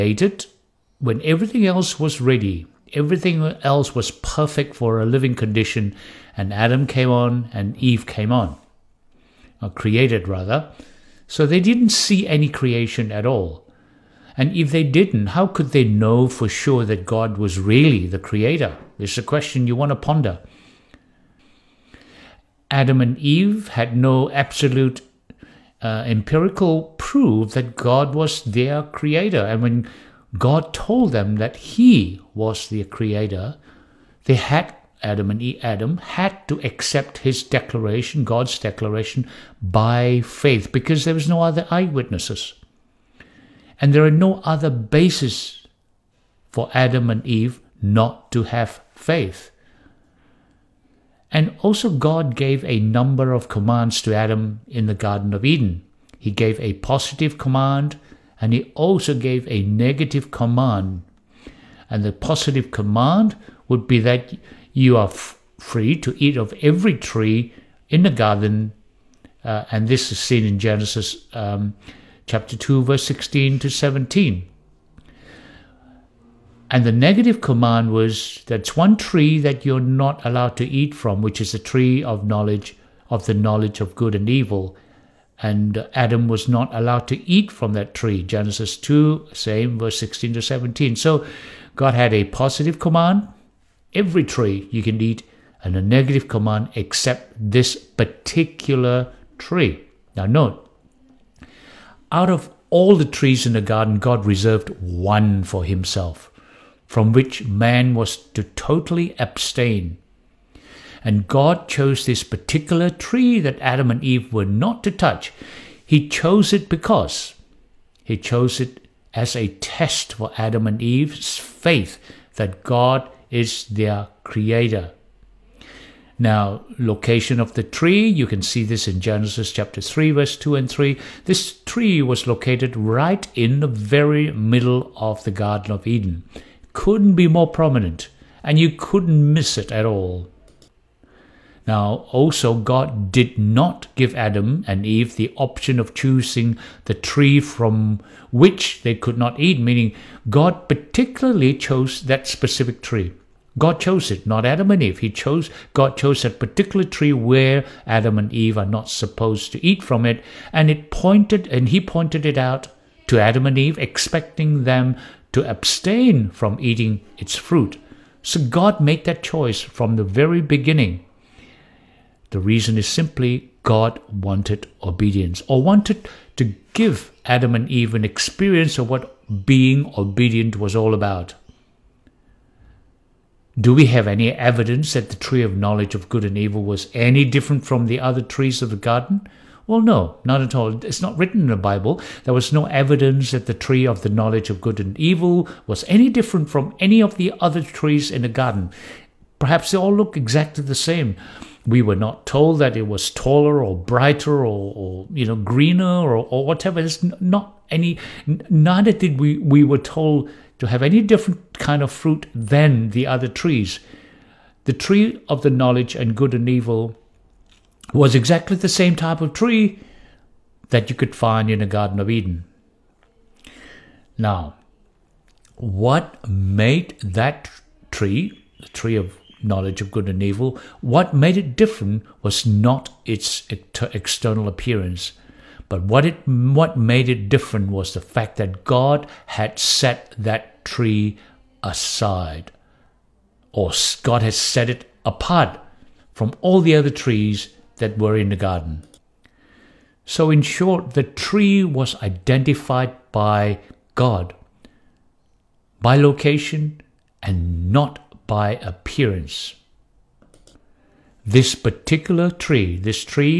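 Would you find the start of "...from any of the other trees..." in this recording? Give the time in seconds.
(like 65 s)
196 s.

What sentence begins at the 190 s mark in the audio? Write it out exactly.
It's not written in the Bible.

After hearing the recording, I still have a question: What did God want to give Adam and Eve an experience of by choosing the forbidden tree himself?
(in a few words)
being obedient.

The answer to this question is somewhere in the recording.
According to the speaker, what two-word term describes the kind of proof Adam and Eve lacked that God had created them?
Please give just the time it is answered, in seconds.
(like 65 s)
26 s.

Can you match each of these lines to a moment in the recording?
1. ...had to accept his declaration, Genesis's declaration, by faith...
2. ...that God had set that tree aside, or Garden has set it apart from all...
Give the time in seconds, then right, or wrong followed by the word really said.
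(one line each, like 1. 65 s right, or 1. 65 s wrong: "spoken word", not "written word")
1. 35 s wrong: "God", not "Genesis"
2. 238 s wrong: "God", not "Garden".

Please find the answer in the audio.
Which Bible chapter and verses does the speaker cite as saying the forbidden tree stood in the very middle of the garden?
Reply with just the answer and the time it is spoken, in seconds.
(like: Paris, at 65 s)
Genesis 3:2-3, at 128 s.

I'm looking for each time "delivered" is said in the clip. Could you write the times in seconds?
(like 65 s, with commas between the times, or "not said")
not said.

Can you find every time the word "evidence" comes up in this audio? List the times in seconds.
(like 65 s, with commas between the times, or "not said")
184 s, 192 s.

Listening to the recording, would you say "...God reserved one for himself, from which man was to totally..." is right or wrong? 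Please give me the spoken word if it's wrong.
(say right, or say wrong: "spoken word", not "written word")
right.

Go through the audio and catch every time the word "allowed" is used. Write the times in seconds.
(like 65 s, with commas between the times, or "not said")
80 s, 86 s.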